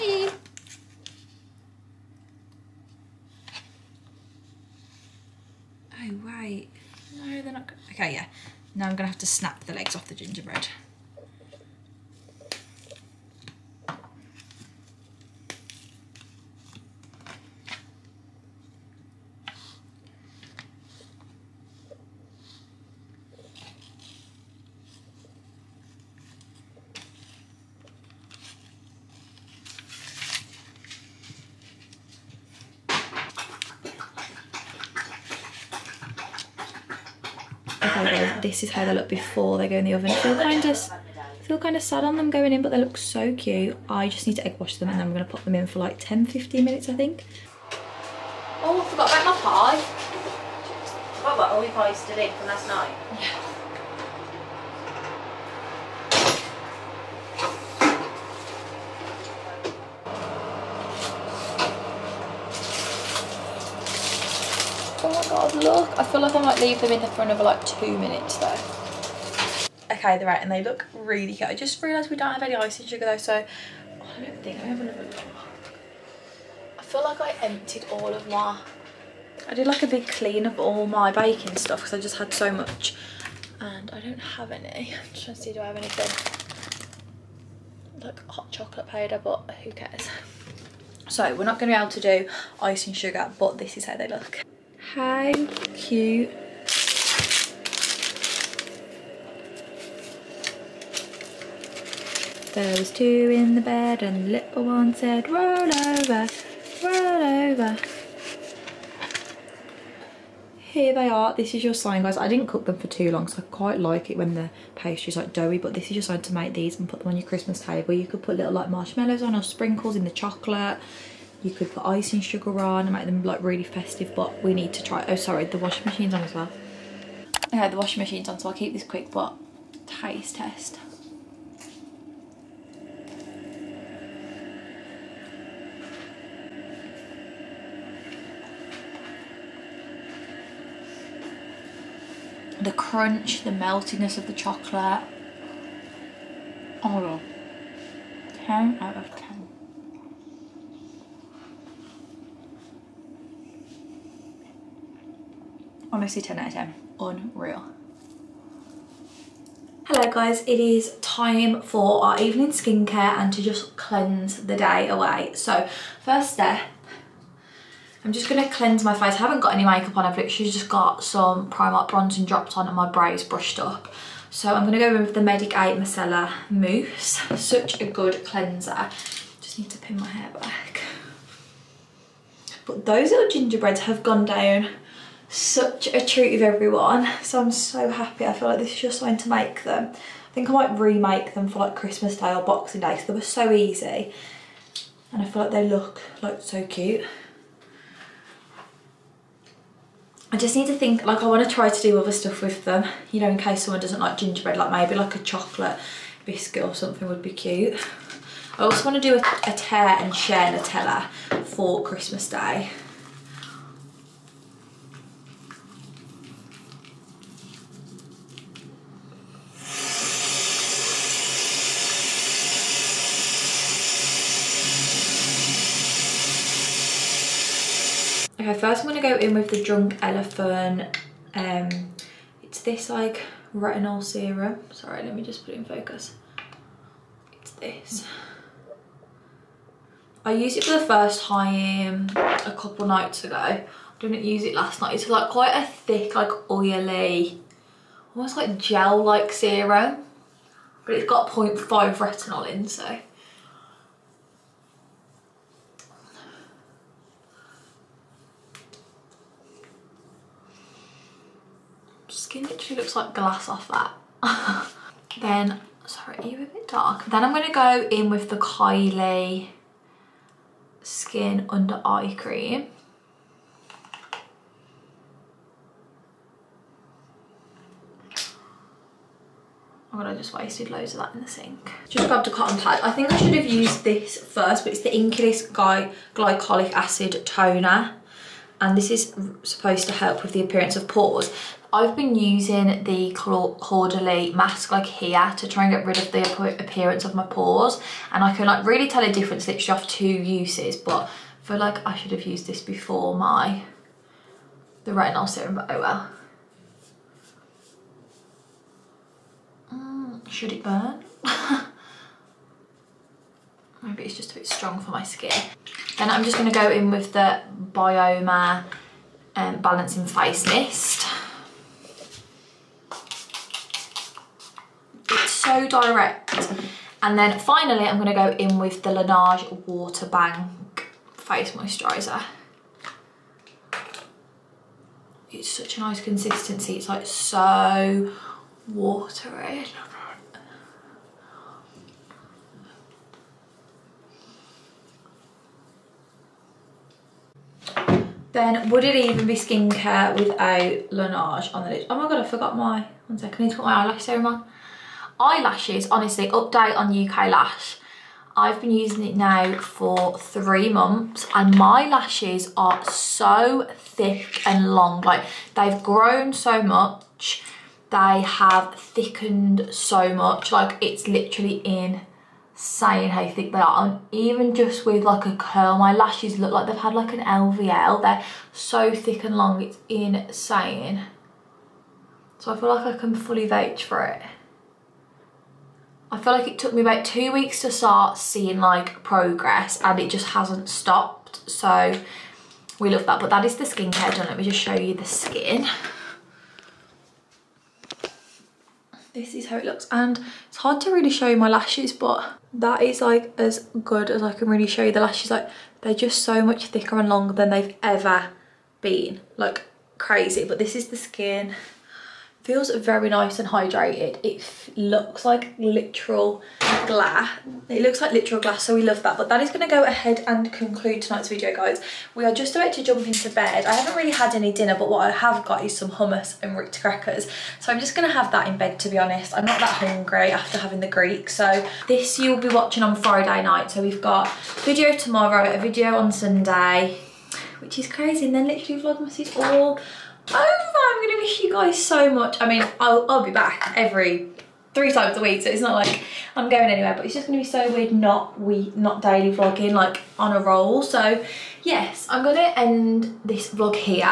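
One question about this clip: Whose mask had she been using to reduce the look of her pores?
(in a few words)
Caudalie.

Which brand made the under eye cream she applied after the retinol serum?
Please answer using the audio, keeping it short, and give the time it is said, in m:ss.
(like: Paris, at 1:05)
Kylie Skin, at 4:28.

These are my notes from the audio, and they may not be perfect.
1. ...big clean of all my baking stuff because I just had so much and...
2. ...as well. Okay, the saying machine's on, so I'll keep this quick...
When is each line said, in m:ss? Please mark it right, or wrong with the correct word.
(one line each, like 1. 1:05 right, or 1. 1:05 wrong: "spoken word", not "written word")
1. 1:19 right
2. 2:06 wrong: "washing", not "saying".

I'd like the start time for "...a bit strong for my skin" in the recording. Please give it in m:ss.
5:14.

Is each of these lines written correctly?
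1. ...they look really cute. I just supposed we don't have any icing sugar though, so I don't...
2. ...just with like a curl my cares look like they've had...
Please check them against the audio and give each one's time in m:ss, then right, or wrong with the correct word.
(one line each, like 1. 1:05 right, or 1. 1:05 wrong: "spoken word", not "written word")
1. 1:10 wrong: "realised", not "supposed"
2. 6:14 wrong: "lashes", not "cares".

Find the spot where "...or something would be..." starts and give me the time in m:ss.
3:26.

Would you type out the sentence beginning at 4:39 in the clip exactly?
Oh god, I just wasted loads of that in the sink.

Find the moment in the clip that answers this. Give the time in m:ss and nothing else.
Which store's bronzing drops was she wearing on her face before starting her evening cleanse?
2:51.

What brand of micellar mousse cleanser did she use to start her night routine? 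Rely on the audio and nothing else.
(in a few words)
Medik8.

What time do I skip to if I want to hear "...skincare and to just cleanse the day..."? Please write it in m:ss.
2:42.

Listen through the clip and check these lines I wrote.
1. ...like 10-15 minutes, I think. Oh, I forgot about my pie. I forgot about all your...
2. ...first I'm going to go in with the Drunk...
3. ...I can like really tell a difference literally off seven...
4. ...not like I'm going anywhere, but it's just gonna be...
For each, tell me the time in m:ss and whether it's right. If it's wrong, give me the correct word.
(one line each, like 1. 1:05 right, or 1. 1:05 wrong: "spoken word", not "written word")
1. 0:45 right
2. 3:48 right
3. 4:58 wrong: "two", not "seven"
4. 7:25 right.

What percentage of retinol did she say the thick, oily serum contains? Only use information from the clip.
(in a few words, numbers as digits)
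0.5.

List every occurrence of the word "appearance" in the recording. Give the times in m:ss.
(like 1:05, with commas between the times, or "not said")
4:50, 4:56.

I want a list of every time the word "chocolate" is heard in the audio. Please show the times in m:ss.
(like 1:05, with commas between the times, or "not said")
1:28, 2:00, 2:24, 3:25.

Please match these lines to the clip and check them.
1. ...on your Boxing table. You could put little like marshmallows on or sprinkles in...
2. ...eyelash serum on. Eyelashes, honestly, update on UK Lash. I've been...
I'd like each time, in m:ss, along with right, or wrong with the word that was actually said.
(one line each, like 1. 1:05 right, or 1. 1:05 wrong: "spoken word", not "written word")
1. 1:57 wrong: "Christmas", not "Boxing"
2. 5:53 right.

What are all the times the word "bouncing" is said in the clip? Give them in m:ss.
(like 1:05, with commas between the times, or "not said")
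not said.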